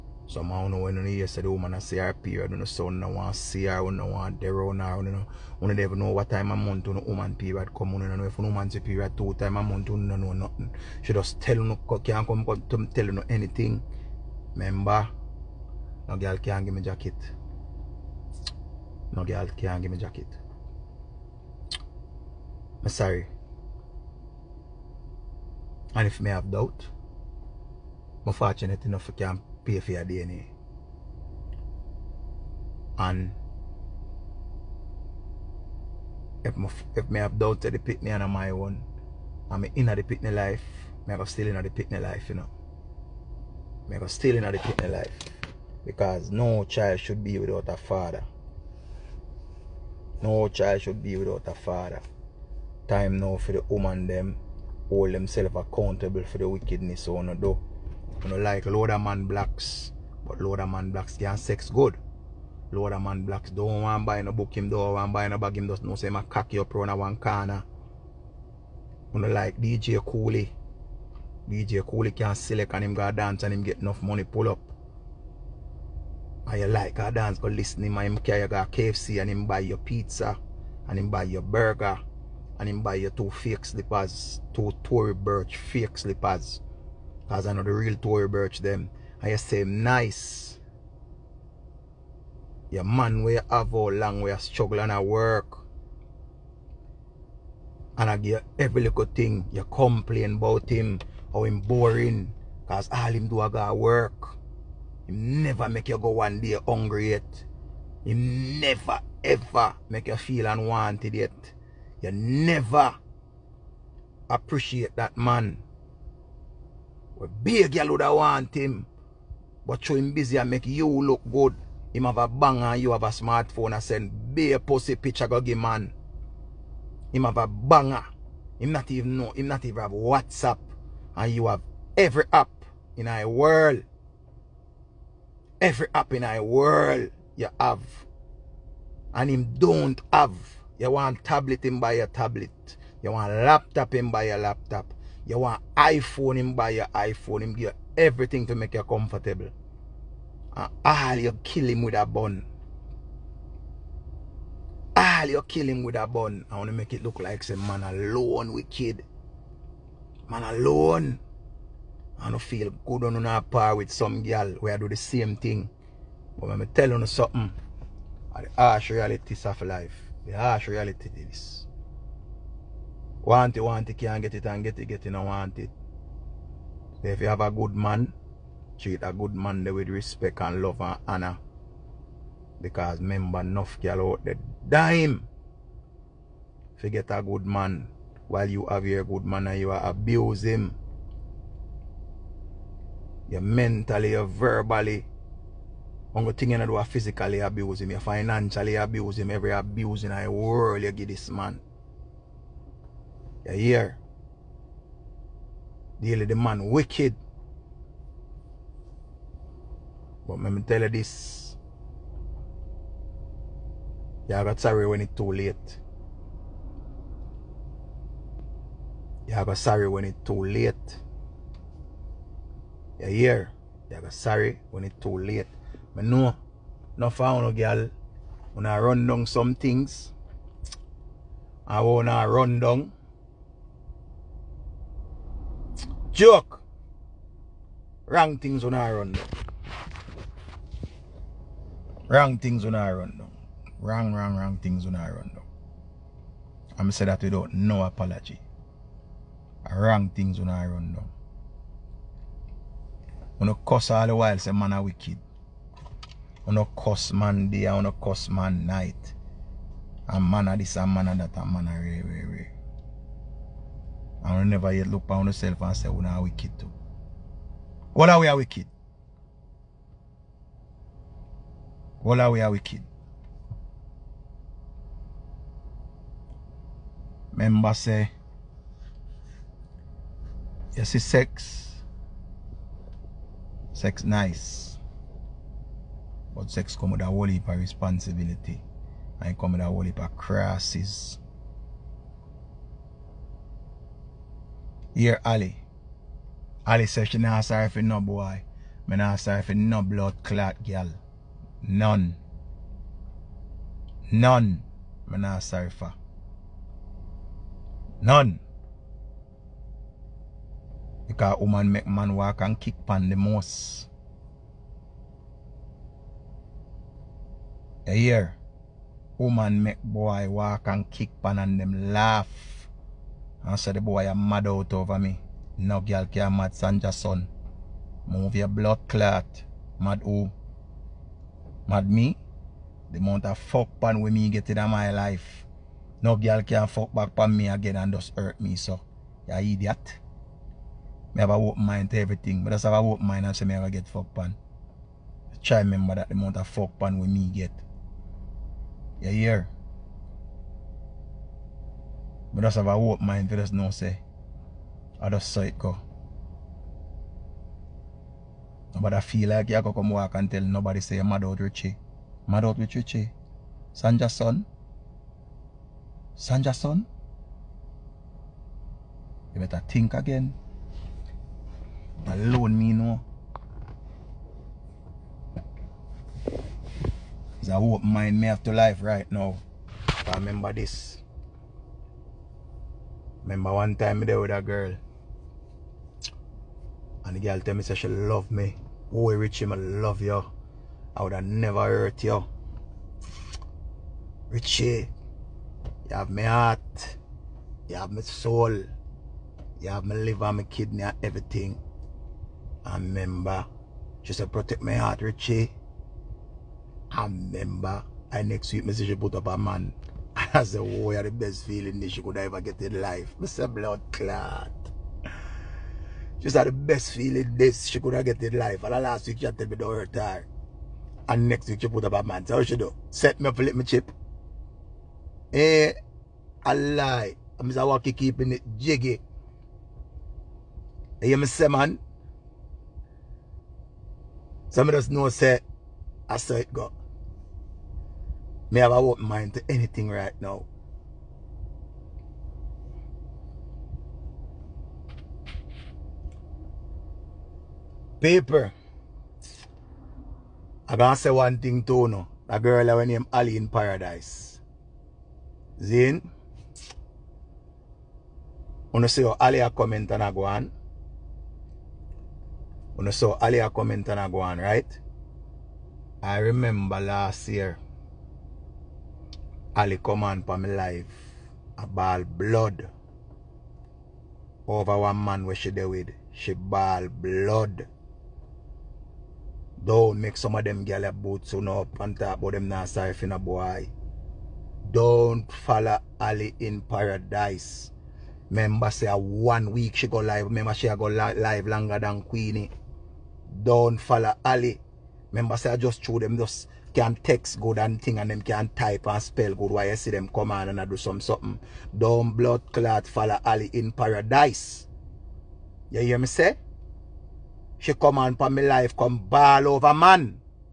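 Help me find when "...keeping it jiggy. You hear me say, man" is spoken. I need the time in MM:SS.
07:07.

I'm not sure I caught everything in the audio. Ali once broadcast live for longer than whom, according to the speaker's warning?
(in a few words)
Queenie.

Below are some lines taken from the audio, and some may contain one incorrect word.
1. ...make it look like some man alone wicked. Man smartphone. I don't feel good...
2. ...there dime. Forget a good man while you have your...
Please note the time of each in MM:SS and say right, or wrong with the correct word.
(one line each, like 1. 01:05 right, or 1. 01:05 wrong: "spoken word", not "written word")
1. 02:36 wrong: "alone", not "smartphone"
2. 03:04 right.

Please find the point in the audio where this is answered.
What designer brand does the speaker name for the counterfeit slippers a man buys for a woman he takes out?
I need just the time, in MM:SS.
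01:24.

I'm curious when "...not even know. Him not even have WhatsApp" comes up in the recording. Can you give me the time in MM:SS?
02:08.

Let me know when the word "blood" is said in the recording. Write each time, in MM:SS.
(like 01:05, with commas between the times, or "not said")
04:59, 05:28, 06:53, 07:52, 07:56, 08:22.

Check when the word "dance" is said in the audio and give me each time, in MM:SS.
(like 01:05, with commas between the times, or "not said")
01:13, 01:17.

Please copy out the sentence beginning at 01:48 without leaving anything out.
He never ever make you feel unwanted yet.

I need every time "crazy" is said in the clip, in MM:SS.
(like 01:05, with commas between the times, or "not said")
not said.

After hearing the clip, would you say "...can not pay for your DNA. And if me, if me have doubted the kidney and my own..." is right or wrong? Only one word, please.
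wrong.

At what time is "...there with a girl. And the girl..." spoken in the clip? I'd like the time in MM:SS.
06:24.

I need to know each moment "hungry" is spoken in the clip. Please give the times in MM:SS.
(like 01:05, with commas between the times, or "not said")
01:46.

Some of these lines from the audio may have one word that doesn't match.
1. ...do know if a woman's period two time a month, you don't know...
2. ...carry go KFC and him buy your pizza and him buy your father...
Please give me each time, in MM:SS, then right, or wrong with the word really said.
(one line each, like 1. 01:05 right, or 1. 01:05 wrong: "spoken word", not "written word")
1. 00:07 right
2. 01:18 wrong: "burger", not "father".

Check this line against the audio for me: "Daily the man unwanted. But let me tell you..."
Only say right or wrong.
wrong.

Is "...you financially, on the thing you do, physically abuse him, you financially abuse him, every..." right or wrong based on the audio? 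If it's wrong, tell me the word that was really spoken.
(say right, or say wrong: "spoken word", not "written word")
wrong: "verbally", not "financially".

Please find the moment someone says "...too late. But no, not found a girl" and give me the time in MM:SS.
03:45.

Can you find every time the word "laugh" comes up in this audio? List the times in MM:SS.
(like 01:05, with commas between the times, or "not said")
05:21.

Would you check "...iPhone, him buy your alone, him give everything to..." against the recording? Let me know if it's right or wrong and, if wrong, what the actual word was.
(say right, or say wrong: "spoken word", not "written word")
wrong: "iPhone", not "alone".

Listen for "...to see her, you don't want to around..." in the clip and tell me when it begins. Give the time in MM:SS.
00:03.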